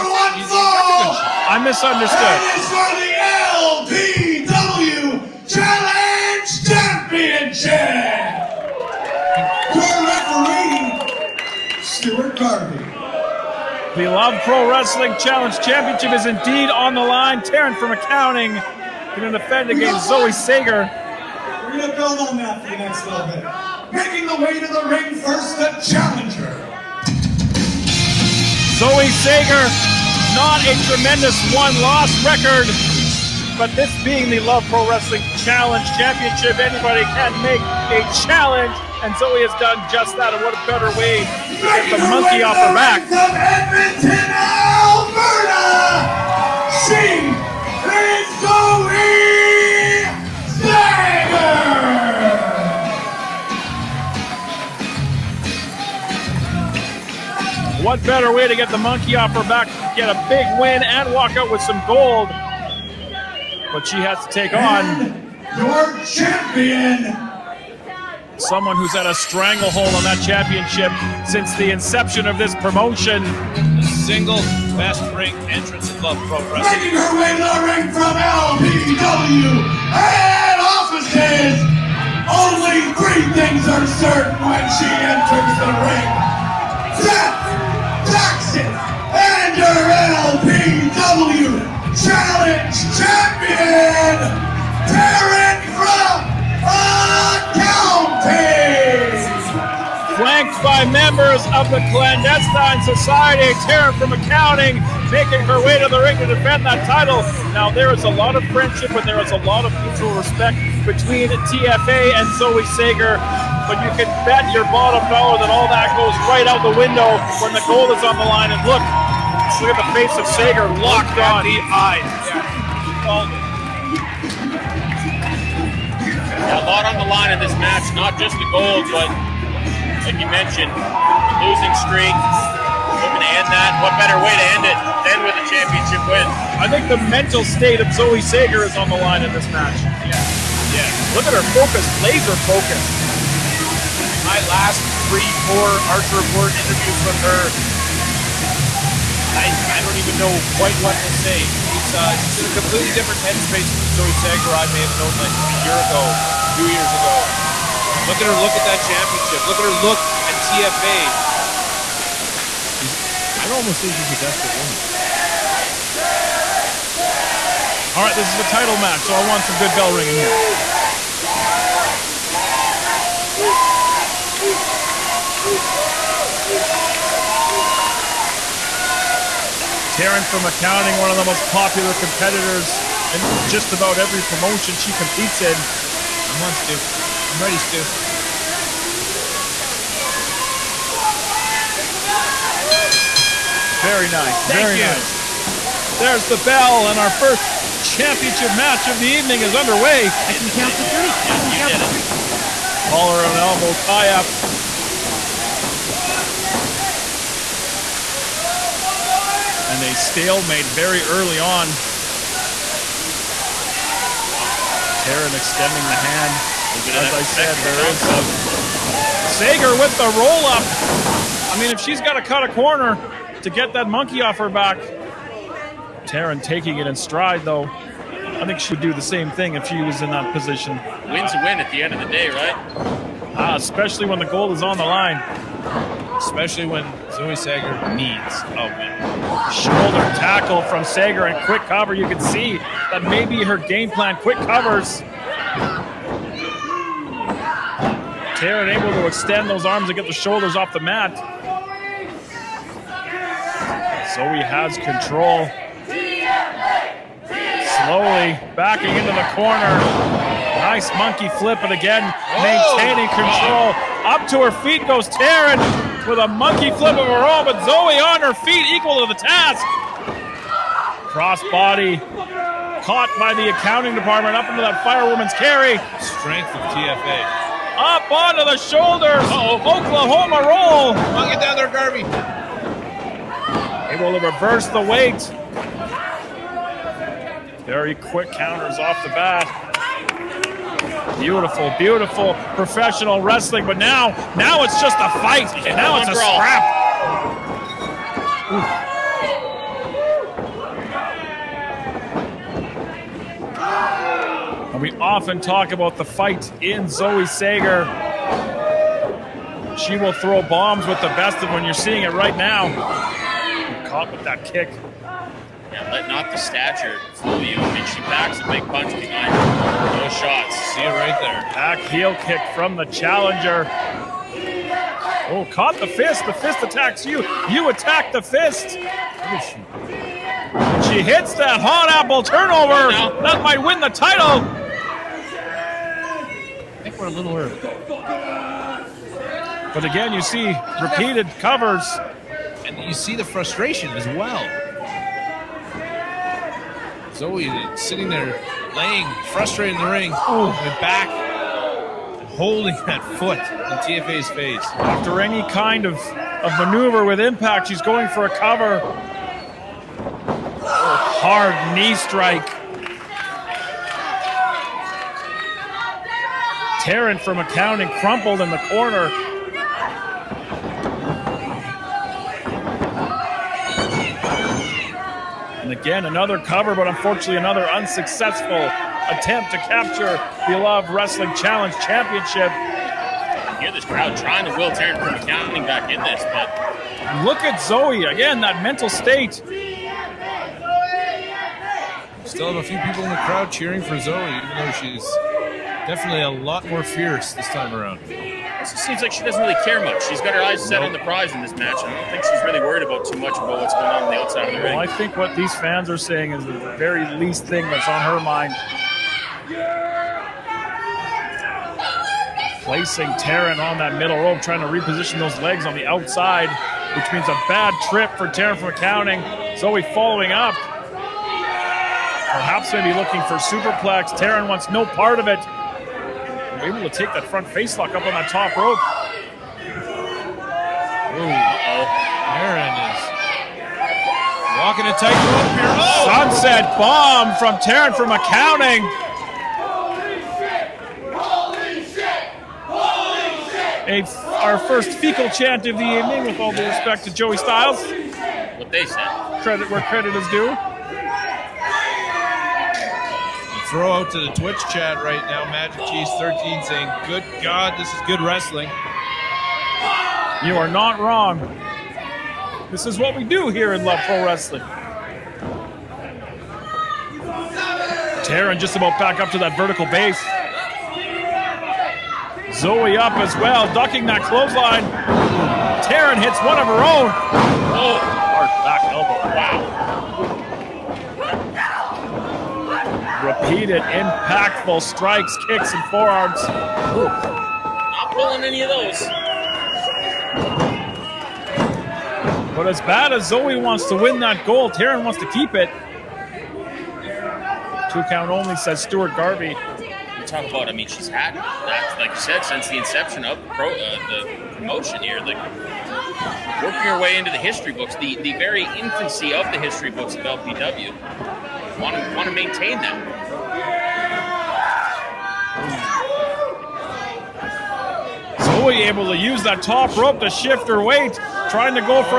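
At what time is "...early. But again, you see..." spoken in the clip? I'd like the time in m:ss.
5:37.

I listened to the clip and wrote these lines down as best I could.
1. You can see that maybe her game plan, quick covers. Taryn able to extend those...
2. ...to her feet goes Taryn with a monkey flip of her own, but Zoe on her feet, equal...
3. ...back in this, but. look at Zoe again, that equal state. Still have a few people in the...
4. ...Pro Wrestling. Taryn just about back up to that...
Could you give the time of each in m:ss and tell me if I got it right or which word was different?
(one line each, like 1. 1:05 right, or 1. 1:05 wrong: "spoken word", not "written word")
1. 4:01 right
2. 4:24 right
3. 6:25 wrong: "mental", not "equal"
4. 7:44 right.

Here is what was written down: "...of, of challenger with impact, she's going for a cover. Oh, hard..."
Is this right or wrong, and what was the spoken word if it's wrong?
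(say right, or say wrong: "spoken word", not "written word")
wrong: "maneuver", not "challenger".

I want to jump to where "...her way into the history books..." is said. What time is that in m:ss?
8:26.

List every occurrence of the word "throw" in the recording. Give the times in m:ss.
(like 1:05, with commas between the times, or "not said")
5:10, 7:33.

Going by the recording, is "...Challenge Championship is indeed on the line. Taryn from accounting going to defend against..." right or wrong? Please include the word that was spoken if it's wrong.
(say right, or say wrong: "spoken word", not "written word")
right.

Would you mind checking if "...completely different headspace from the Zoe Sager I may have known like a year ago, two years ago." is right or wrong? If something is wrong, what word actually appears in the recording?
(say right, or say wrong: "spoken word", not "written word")
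right.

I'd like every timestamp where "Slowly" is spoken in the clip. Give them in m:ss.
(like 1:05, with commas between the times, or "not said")
4:17.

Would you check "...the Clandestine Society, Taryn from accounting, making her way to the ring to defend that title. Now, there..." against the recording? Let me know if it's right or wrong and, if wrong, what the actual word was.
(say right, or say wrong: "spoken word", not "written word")
right.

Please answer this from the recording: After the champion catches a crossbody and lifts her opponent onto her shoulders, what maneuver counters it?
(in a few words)
Oklahoma roll.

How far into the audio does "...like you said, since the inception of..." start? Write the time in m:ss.
8:21.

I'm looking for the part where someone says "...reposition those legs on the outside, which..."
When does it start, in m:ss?
6:54.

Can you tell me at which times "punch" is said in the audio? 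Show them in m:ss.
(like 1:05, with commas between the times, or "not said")
5:18.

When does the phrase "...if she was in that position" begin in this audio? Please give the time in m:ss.
3:49.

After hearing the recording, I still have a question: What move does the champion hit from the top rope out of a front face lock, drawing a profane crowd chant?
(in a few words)
Sunset bomb.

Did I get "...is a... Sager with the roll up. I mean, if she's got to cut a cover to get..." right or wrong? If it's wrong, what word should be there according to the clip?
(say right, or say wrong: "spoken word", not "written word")
wrong: "corner", not "cover".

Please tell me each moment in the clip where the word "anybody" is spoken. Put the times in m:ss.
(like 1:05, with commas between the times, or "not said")
0:36.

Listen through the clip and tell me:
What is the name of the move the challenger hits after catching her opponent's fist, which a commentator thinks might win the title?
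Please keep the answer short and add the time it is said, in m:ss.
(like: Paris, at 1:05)
hot apple turnover, at 5:31.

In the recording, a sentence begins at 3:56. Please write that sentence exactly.
Especially when Zoe Sager needs a win.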